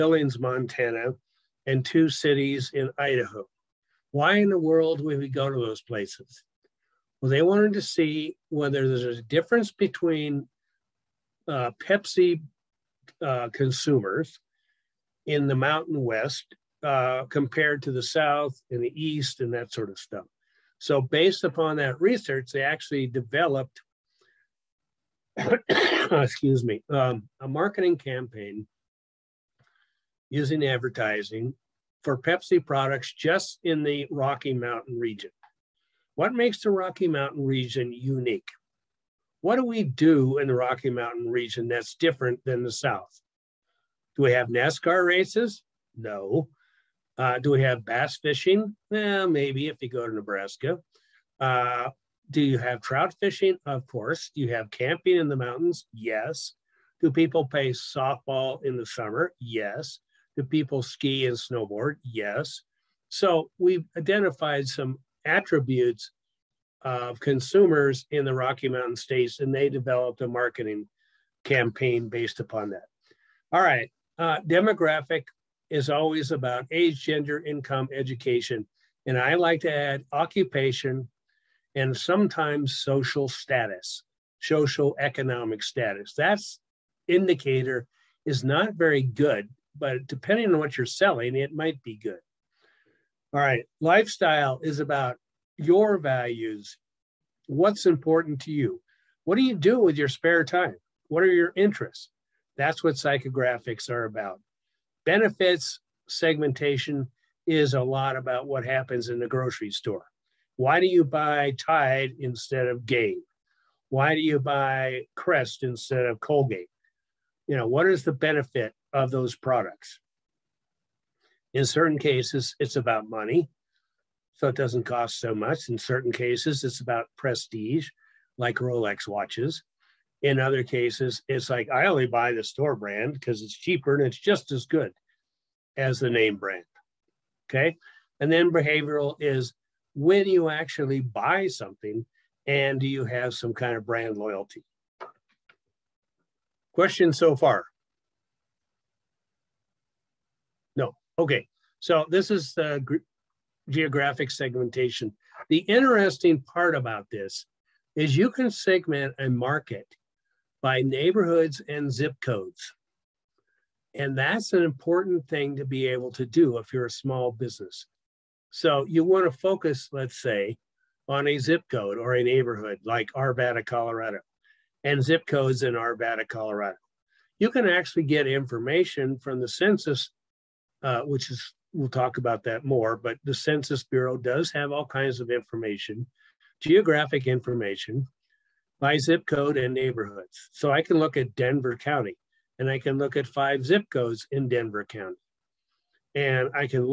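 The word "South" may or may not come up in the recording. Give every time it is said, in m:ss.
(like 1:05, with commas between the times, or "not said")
0:18, 0:42.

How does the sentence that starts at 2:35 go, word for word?
The interesting part about this is you can segment a market by neighborhoods and zip codes.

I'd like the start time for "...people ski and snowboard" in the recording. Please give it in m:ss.
1:00.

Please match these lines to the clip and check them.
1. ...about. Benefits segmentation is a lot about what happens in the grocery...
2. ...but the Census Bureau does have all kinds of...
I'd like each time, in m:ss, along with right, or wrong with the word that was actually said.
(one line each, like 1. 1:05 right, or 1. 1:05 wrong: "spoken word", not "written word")
1. 1:44 right
2. 3:02 right.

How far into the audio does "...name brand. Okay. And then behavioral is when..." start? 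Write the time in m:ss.
2:16.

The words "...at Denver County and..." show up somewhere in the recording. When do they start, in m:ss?
3:11.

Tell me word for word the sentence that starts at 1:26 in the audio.
That's indicator is not very good, but depending on what you're selling, it might be good.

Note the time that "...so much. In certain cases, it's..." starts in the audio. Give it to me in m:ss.
2:05.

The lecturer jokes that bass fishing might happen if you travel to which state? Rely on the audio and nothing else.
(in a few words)
Nebraska.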